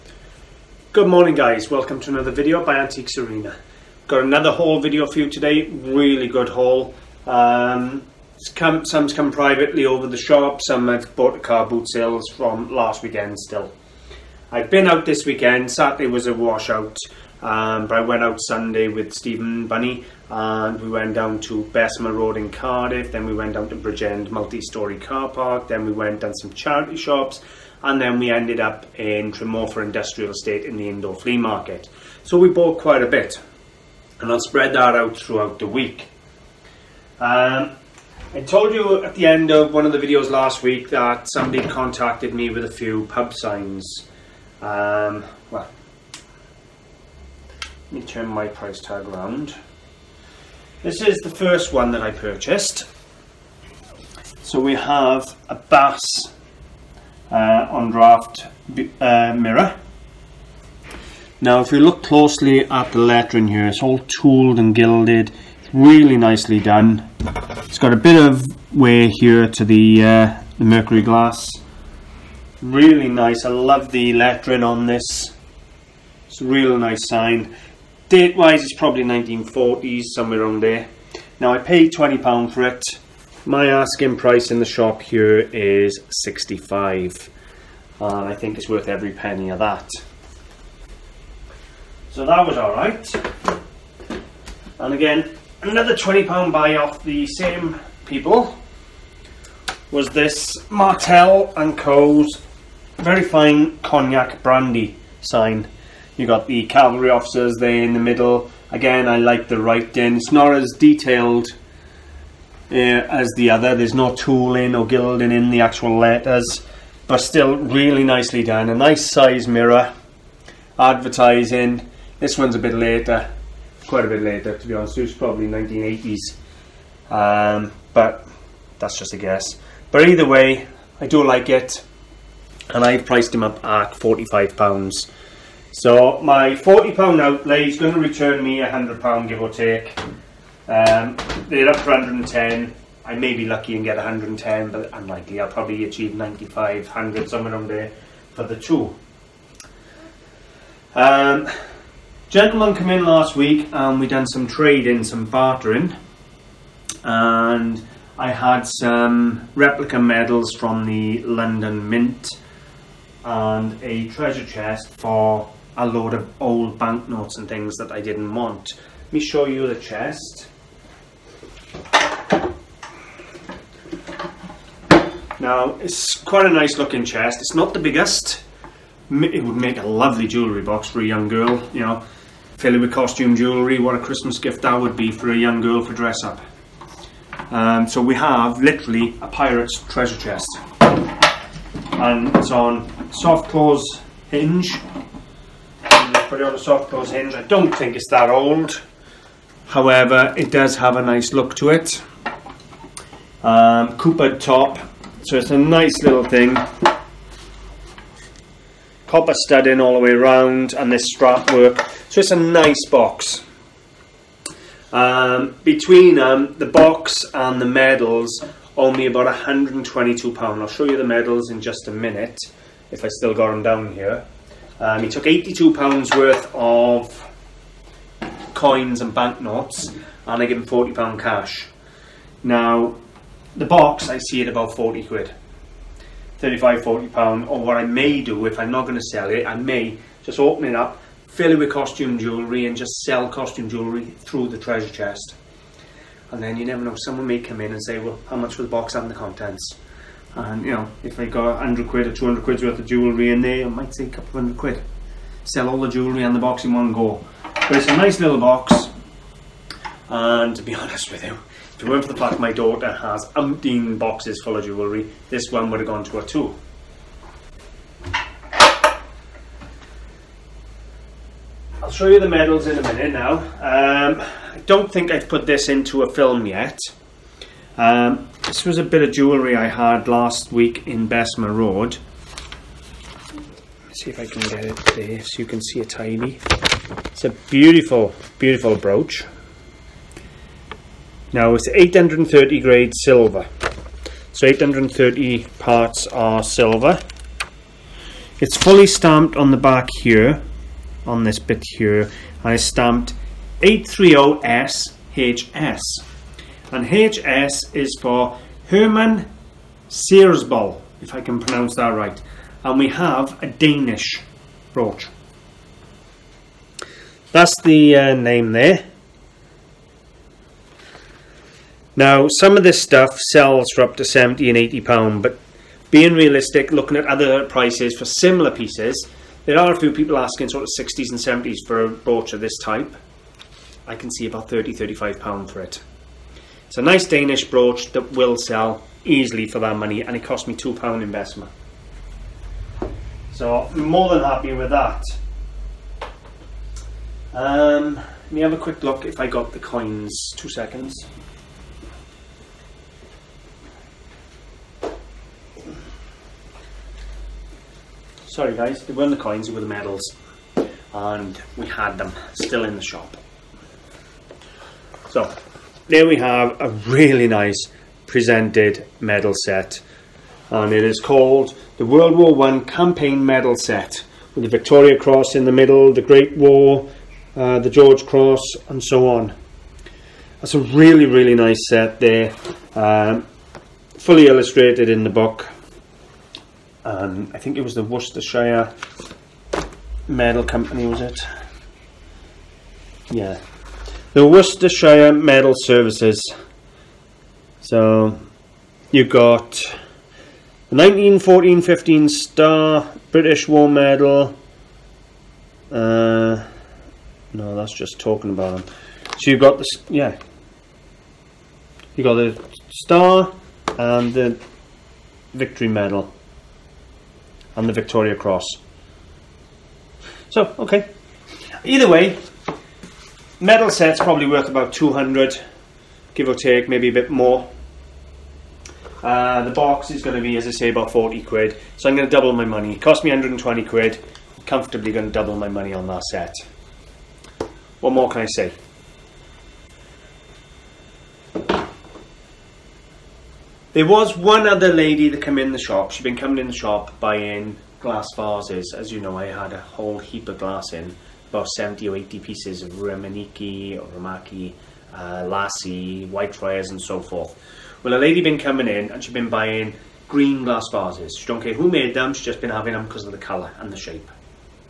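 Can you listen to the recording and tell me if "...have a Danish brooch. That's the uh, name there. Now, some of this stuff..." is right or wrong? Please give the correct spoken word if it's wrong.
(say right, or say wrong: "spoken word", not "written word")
right.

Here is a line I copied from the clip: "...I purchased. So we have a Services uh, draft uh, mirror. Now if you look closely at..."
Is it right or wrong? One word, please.
wrong.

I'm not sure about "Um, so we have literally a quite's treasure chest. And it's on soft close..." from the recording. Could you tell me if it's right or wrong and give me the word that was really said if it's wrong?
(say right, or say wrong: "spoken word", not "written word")
wrong: "pirate", not "quite".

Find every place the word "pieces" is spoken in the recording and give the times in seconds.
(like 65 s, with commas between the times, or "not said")
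328 s, 452 s.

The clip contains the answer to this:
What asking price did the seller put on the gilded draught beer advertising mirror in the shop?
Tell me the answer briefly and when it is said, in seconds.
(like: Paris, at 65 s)
£65, at 86 s.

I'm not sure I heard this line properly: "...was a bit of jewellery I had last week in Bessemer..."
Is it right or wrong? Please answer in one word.
right.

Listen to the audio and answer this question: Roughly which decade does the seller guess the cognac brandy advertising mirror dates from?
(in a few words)
1980s.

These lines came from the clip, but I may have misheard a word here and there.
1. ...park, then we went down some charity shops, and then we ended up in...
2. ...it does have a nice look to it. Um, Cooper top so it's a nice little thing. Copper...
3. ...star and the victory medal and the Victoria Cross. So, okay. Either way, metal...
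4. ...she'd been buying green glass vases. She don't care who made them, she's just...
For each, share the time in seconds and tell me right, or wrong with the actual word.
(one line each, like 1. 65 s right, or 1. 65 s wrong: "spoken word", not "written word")
1. 25 s right
2. 200 s right
3. 412 s right
4. 459 s right.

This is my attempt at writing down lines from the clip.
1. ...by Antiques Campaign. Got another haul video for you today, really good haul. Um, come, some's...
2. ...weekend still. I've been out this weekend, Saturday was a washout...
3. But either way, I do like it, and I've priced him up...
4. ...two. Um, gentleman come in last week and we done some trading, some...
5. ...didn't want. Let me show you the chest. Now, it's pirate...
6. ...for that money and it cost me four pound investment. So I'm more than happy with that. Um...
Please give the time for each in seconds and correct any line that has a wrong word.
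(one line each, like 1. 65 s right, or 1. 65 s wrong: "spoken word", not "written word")
1. 2 s wrong: "Arena", not "Campaign"
2. 13 s right
3. 129 s right
4. 148 s right
5. 168 s wrong: "quite", not "pirate"
6. 339 s wrong: "two", not "four".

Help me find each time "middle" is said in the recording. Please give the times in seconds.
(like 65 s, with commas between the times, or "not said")
107 s, 375 s.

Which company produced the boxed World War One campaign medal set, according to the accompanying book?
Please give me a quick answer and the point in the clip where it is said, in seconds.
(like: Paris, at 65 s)
Worcestershire Medal Services, at 394 s.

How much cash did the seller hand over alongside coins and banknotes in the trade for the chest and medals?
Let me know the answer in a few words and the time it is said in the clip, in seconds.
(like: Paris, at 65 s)
£40, at 230 s.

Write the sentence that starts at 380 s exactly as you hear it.
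That's a really, really nice set there.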